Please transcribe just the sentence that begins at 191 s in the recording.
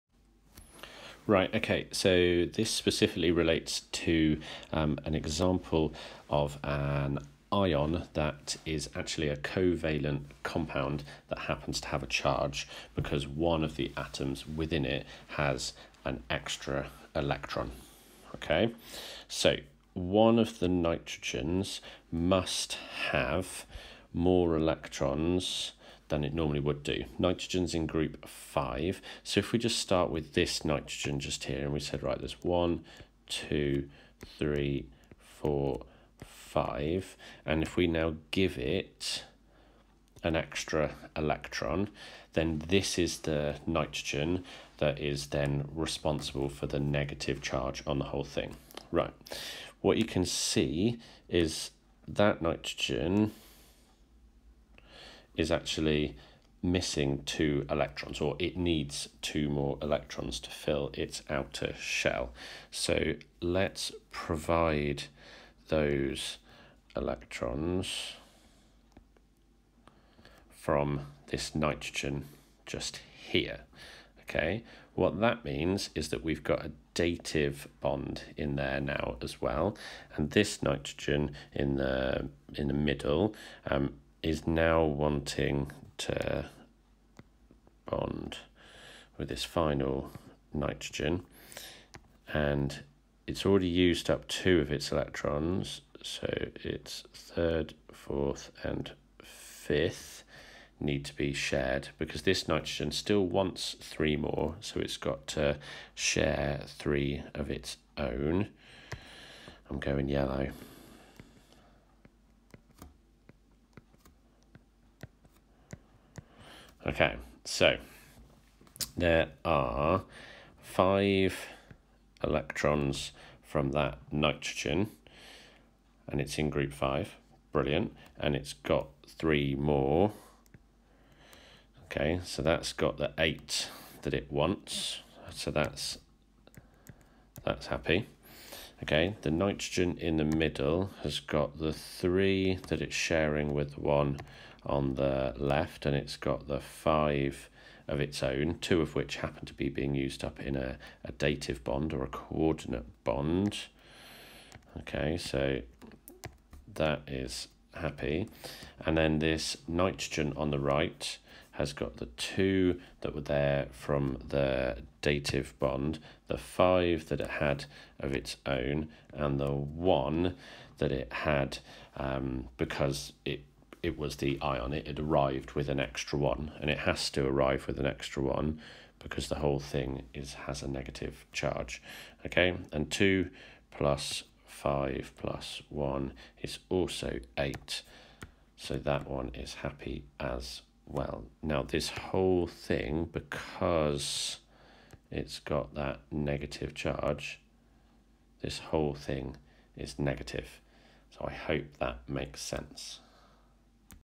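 Now, this whole thing, because it's got that negative charge, this whole thing is negative.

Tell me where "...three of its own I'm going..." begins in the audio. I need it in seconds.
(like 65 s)
106 s.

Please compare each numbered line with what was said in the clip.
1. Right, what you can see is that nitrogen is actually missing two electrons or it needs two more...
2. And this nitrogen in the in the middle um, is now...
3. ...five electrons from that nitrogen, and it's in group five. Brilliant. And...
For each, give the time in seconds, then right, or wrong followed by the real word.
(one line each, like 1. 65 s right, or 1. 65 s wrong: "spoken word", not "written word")
1. 48 s right
2. 80 s right
3. 120 s right.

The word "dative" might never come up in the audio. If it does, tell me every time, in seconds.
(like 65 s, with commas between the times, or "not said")
76 s, 151 s, 165 s.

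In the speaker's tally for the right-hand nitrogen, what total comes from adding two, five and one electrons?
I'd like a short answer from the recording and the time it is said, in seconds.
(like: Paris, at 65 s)
8, at 187 s.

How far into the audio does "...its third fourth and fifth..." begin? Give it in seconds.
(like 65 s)
96 s.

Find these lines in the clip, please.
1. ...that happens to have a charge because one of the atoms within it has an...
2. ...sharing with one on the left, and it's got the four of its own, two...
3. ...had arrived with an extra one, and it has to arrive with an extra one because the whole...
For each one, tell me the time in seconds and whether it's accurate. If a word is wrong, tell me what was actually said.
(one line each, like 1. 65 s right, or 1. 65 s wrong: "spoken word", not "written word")
1. 11 s right
2. 142 s wrong: "five", not "four"
3. 174 s right.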